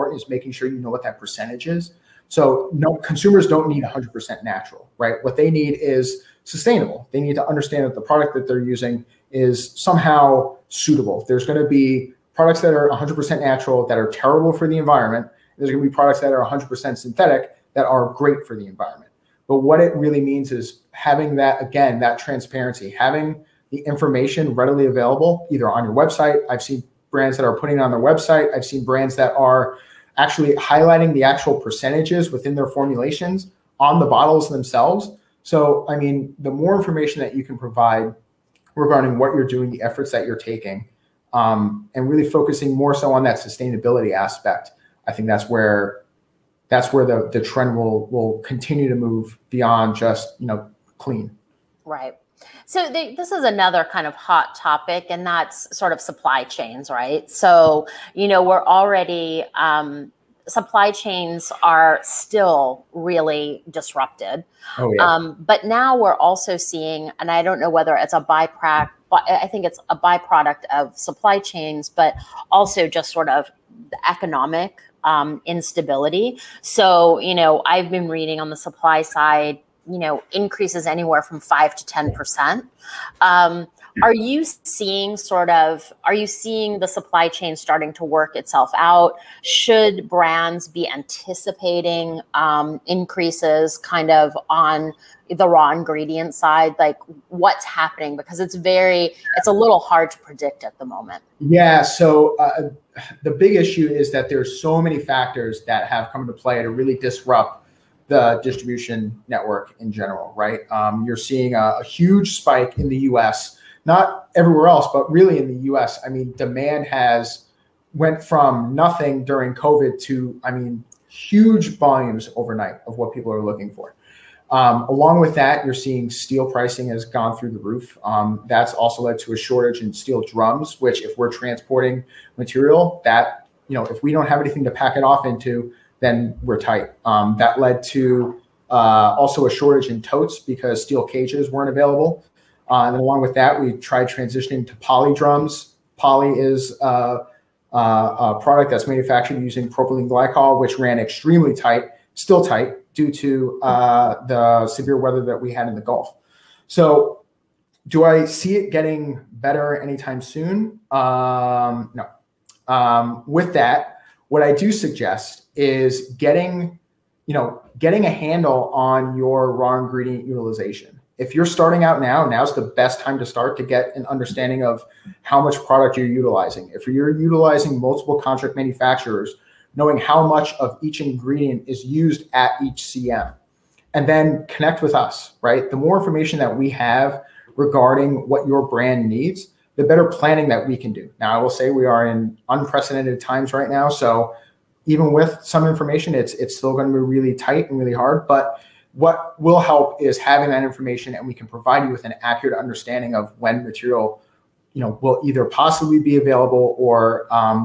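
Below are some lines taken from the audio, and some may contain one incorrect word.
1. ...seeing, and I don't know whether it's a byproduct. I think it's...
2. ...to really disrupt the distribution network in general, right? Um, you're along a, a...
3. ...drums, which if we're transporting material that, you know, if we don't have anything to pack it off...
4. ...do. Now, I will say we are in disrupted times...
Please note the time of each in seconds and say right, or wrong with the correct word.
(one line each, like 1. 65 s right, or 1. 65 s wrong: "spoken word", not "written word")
1. 66 s right
2. 106 s wrong: "seeing", not "along"
3. 130 s right
4. 190 s wrong: "unprecedented", not "disrupted".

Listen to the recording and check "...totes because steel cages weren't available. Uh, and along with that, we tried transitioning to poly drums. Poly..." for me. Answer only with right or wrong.
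right.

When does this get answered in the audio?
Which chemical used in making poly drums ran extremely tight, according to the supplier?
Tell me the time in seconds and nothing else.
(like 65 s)
149 s.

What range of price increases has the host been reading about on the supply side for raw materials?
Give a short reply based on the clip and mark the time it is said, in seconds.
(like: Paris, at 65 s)
5 to 10 percent, at 81 s.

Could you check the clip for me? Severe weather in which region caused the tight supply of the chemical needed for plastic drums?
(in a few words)
The Gulf.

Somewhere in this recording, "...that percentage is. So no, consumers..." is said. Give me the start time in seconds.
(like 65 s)
1 s.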